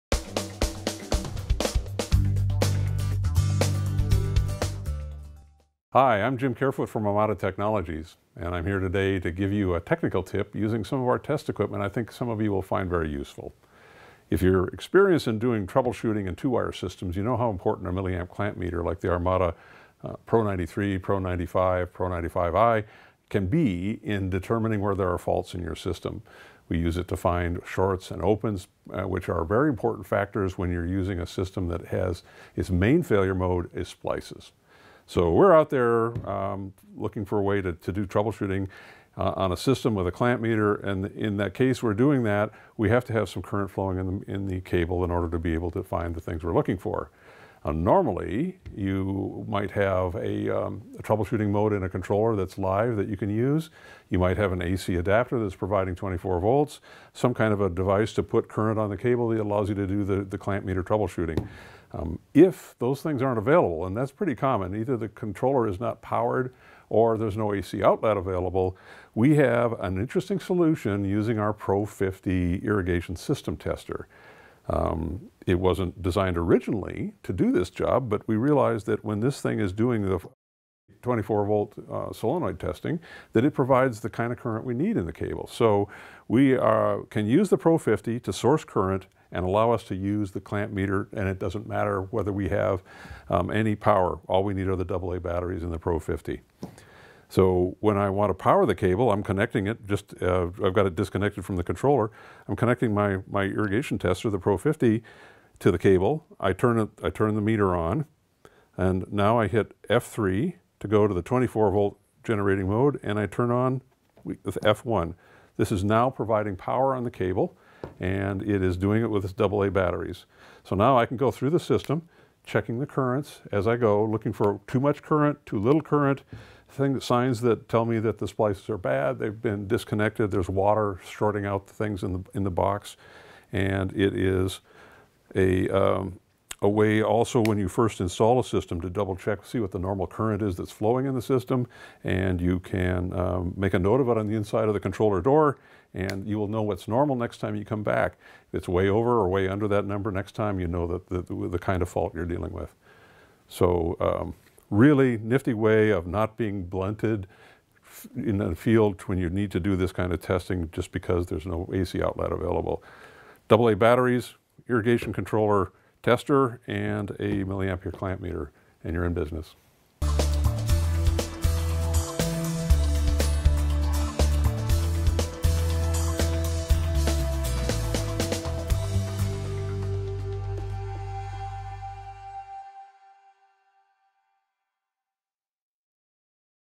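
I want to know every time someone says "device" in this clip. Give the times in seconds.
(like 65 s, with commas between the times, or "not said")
57 s.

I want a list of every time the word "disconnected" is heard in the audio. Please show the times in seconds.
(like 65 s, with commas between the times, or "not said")
100 s, 129 s.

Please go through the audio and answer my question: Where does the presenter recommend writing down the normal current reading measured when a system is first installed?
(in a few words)
Inside of the controller door.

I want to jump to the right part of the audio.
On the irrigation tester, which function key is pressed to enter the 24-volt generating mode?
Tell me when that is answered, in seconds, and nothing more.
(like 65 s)
109 s.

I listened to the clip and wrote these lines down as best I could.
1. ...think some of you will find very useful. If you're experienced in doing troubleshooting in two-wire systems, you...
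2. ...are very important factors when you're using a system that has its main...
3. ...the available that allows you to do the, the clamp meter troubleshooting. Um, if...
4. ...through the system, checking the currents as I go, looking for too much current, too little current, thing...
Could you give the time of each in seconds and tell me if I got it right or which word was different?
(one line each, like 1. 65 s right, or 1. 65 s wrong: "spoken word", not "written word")
1. 11 s right
2. 29 s right
3. 58 s wrong: "cable", not "available"
4. 121 s right.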